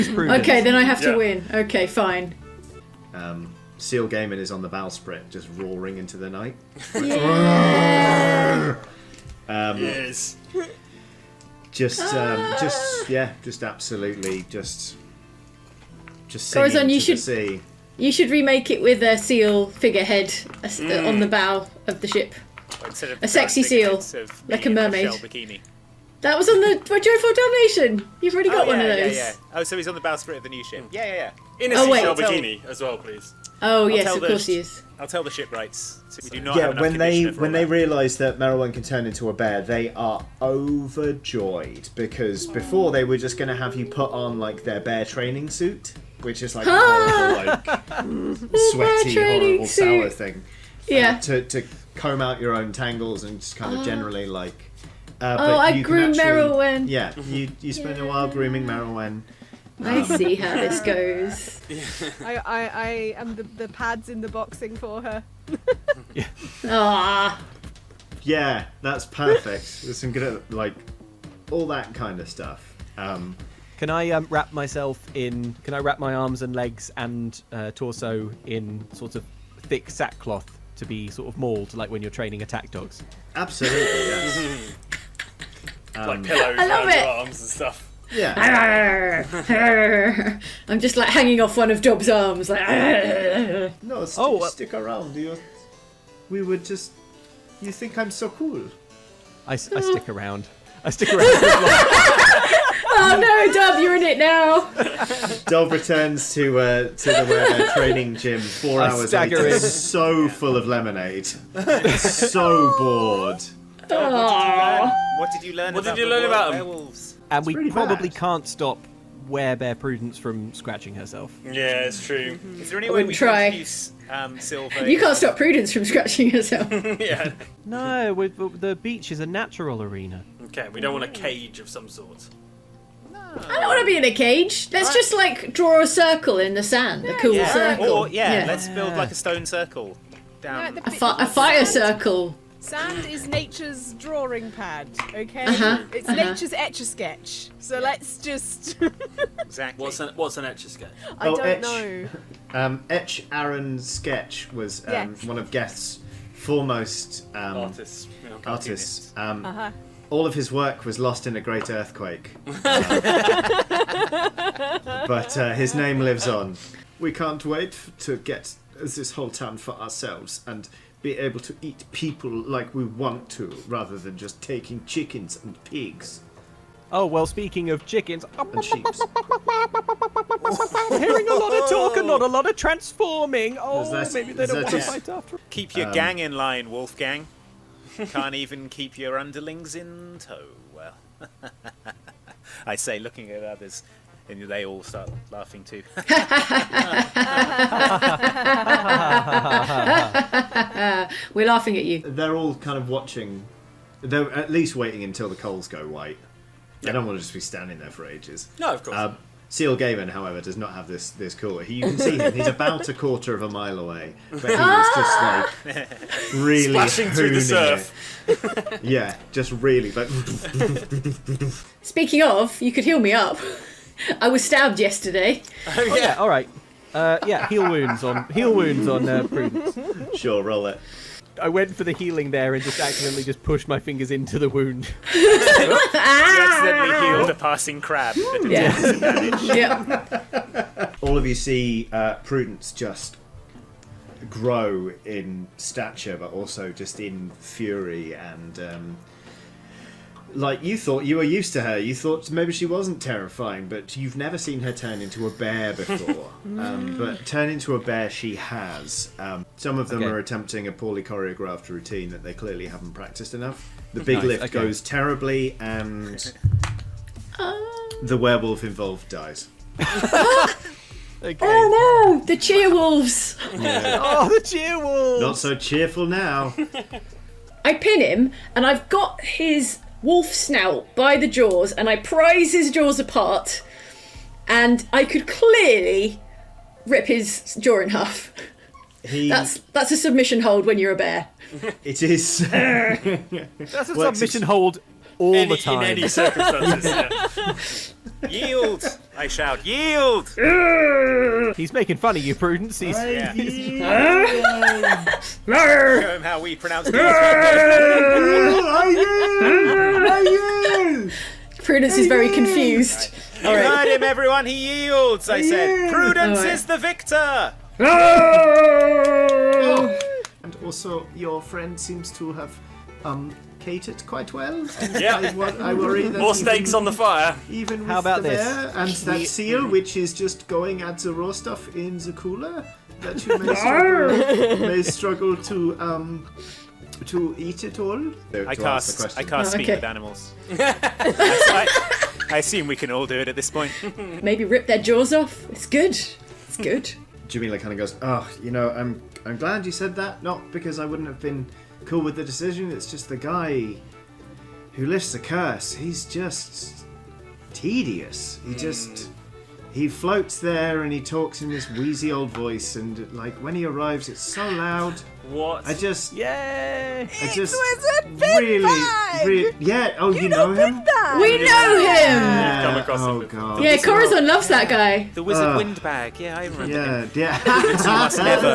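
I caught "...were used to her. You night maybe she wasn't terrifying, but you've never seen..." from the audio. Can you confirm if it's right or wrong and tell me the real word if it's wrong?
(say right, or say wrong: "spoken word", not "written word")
wrong: "thought", not "night".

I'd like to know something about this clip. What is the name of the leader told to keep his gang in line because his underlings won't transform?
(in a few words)
Wolfgang.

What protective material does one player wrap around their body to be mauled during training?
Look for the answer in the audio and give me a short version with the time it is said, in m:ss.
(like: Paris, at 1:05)
Thick sackcloth, at 1:19.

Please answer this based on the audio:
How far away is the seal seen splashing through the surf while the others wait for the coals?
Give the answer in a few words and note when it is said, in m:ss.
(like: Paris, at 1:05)
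A quarter of a mile, at 3:32.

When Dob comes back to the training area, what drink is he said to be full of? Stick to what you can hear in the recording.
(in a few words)
Lemonade.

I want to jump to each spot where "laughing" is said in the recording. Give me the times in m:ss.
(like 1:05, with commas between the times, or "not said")
3:15, 3:21.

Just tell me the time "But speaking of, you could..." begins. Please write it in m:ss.
3:39.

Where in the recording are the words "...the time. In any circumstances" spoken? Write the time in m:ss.
4:55.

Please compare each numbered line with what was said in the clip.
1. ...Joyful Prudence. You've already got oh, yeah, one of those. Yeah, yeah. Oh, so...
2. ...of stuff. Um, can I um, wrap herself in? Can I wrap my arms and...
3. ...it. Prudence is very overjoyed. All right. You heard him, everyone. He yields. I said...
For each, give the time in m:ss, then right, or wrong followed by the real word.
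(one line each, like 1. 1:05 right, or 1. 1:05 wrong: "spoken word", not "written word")
1. 0:26 wrong: "Damnation", not "Prudence"
2. 1:12 wrong: "myself", not "herself"
3. 5:06 wrong: "confused", not "overjoyed".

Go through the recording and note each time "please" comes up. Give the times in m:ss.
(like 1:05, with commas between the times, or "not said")
0:32.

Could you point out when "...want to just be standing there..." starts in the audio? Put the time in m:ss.
3:27.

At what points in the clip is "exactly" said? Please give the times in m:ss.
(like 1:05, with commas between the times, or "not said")
2:29.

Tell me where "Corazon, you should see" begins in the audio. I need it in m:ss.
0:16.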